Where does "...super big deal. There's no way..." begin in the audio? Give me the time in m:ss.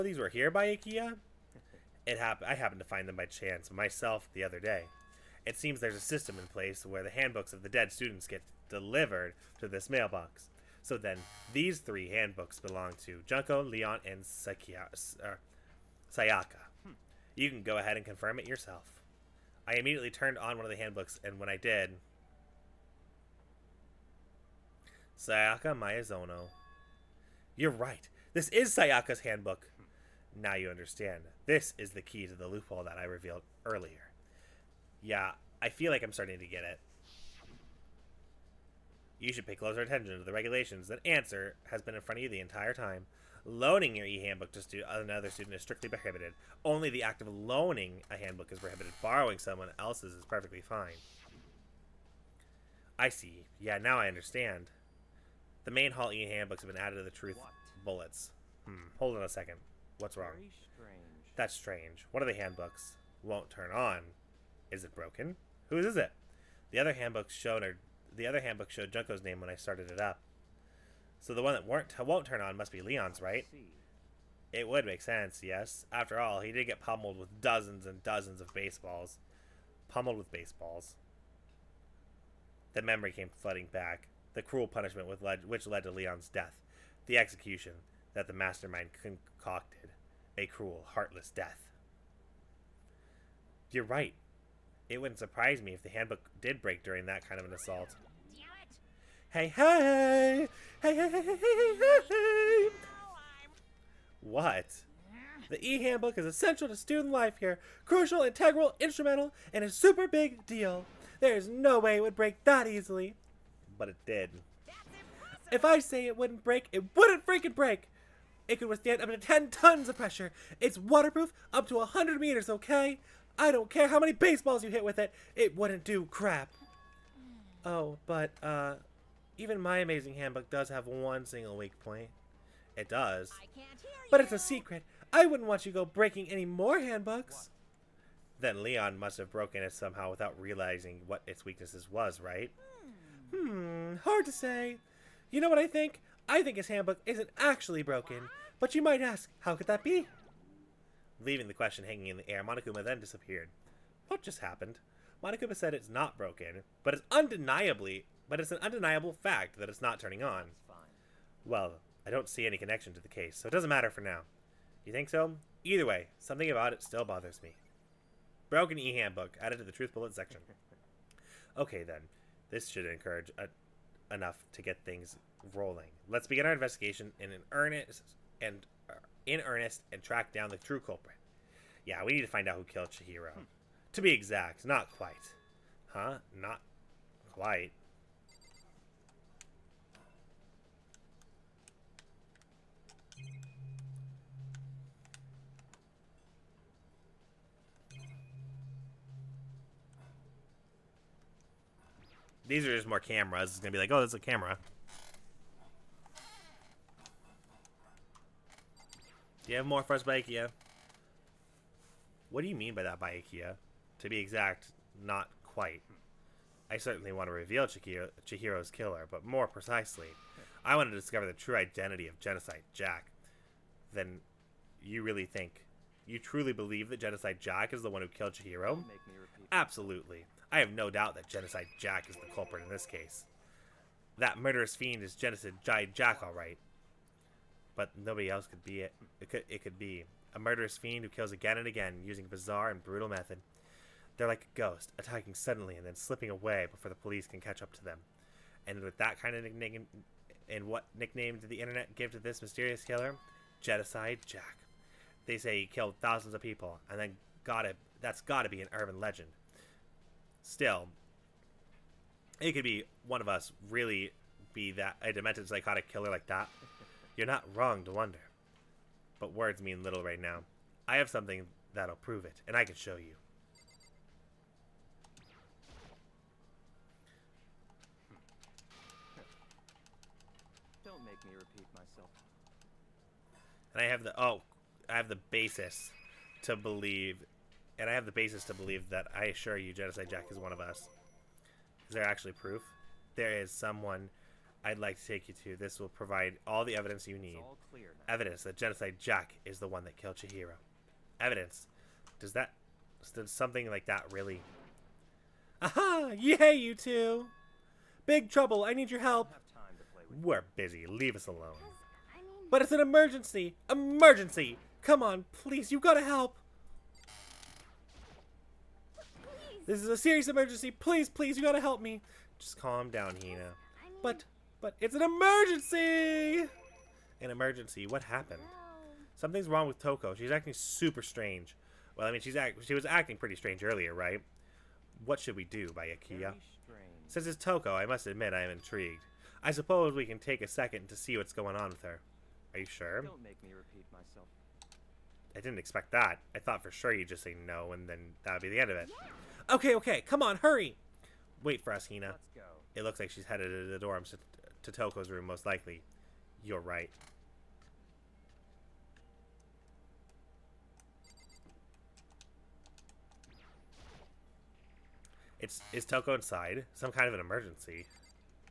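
1:49.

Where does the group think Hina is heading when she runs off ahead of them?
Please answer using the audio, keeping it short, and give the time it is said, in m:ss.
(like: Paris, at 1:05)
The dorms, at 5:53.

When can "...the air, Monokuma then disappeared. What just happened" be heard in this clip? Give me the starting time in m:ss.
2:32.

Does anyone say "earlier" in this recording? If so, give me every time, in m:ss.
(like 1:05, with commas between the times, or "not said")
0:33, 5:33.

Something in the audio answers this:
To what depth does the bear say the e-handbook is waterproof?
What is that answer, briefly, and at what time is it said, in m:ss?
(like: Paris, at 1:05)
100 meters, at 2:01.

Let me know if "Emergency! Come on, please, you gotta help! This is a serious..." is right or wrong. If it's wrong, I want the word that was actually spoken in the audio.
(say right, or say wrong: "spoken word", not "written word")
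right.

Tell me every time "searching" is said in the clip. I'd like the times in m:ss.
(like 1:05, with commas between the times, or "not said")
not said.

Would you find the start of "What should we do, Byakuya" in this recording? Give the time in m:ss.
5:35.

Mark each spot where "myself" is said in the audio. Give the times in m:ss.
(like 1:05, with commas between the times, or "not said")
0:03, 4:41, 5:43.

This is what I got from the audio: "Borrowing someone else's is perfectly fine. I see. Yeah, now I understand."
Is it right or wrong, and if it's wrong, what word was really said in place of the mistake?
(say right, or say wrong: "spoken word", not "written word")
right.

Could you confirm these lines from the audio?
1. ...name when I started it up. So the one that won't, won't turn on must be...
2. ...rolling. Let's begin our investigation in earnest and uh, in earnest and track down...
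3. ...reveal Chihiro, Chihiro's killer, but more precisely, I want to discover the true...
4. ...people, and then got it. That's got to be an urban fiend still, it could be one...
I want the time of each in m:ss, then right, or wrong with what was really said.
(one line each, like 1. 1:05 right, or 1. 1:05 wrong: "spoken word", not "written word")
1. 1:09 right
2. 2:55 right
3. 3:37 right
4. 4:16 wrong: "legend", not "fiend".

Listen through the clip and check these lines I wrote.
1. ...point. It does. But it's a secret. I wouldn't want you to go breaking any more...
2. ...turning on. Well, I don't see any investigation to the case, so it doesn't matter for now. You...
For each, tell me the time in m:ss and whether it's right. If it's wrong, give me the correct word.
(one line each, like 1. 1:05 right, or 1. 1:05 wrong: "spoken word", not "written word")
1. 2:11 right
2. 2:39 wrong: "connection", not "investigation".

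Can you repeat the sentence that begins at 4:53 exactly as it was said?
There is someone I'd like to take you to.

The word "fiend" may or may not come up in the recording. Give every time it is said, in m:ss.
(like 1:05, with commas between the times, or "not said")
3:54, 4:00.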